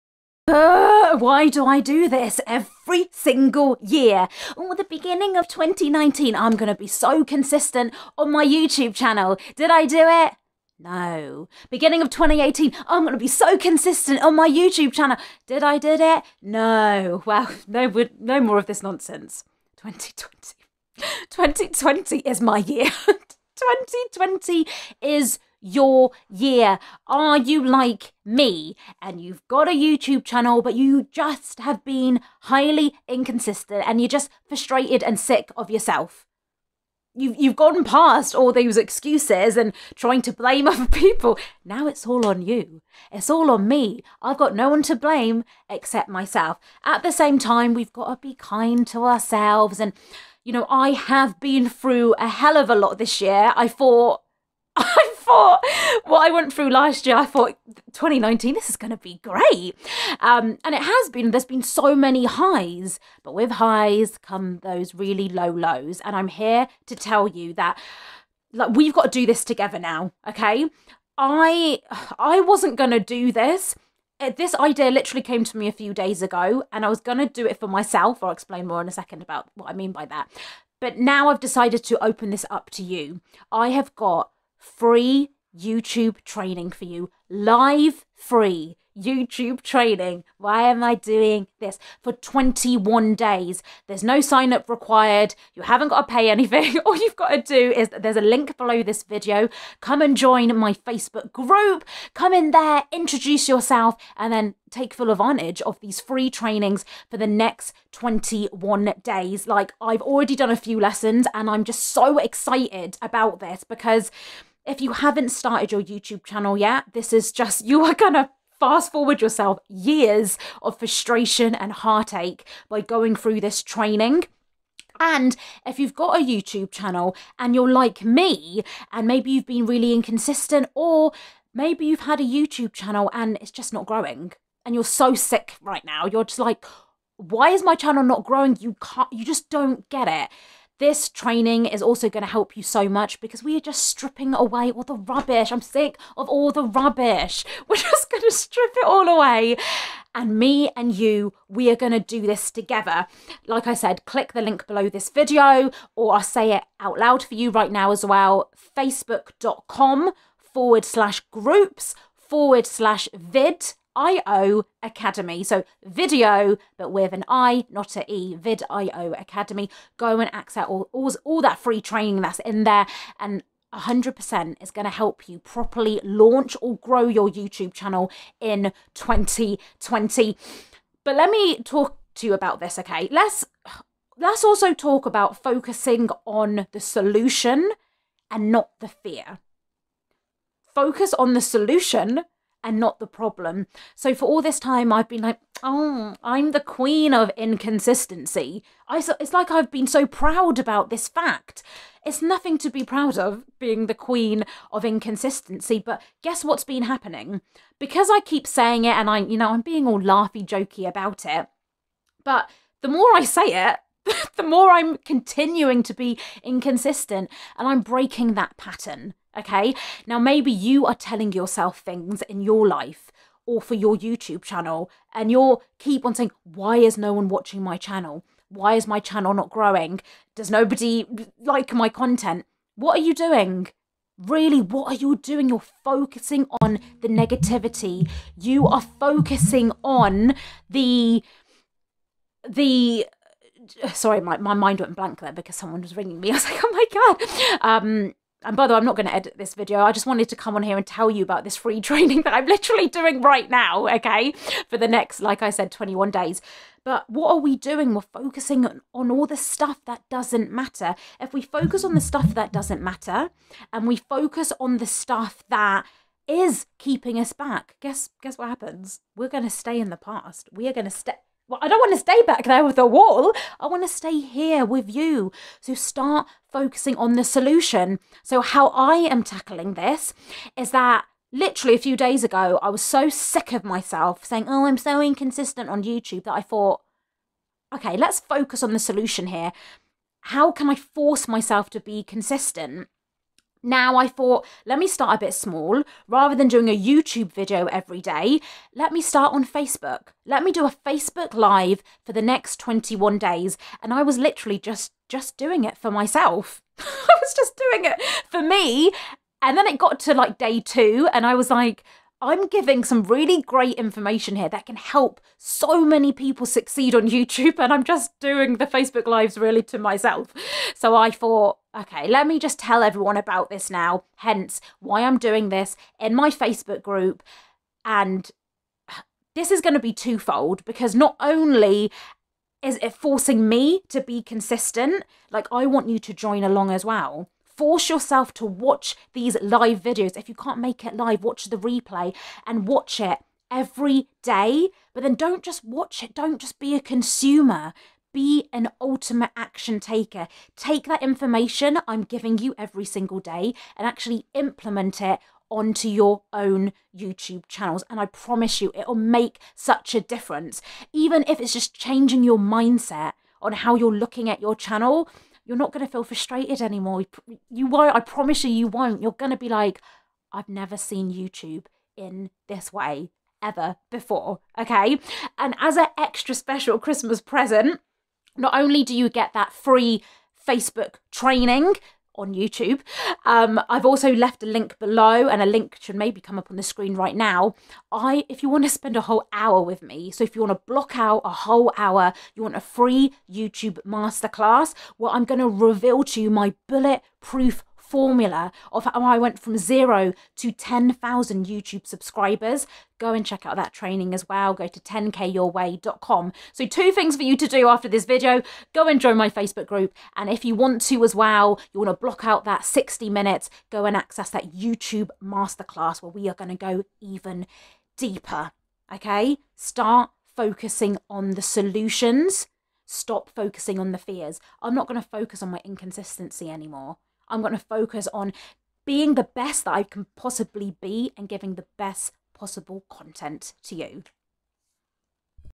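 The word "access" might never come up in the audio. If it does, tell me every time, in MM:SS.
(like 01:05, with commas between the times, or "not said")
02:50, 06:53.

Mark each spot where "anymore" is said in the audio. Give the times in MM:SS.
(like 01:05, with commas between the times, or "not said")
06:06, 07:06.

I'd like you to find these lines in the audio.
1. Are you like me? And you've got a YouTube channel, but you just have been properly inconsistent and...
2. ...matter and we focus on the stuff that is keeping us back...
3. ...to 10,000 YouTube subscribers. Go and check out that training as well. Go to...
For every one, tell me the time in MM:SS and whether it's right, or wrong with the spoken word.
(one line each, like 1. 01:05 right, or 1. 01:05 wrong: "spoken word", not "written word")
1. 00:27 wrong: "highly", not "properly"
2. 04:22 right
3. 06:40 right.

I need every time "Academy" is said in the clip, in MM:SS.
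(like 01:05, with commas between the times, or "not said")
02:44, 02:49.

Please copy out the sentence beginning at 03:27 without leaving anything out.
Because I keep saying it and I, you know, I'm being all laughy jokey about it.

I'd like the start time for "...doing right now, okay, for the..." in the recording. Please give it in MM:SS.
04:12.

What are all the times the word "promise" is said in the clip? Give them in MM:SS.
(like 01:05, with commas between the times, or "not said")
05:58, 06:07.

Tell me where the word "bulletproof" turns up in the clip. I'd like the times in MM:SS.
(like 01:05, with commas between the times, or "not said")
06:36.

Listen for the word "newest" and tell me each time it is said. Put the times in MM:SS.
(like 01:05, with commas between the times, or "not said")
not said.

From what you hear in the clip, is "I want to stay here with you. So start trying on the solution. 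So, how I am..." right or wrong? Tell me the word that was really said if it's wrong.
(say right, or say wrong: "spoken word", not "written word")
wrong: "focusing", not "trying".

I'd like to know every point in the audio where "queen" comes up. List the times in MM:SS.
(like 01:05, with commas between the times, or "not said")
03:16, 03:23.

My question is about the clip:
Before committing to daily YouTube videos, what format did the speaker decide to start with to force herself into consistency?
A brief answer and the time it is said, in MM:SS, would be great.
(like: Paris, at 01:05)
Facebook Live, at 05:00.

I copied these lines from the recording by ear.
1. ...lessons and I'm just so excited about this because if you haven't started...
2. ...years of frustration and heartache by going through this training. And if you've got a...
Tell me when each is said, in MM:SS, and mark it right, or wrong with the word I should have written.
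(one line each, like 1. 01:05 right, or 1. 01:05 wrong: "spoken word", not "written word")
1. 01:50 right
2. 01:59 right.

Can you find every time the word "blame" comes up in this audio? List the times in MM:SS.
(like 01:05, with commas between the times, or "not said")
00:40, 00:44.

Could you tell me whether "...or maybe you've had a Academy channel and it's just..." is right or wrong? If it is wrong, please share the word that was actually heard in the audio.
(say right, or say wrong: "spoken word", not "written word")
wrong: "YouTube", not "Academy".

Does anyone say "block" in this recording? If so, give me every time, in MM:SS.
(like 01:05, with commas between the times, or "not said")
06:30, 06:52.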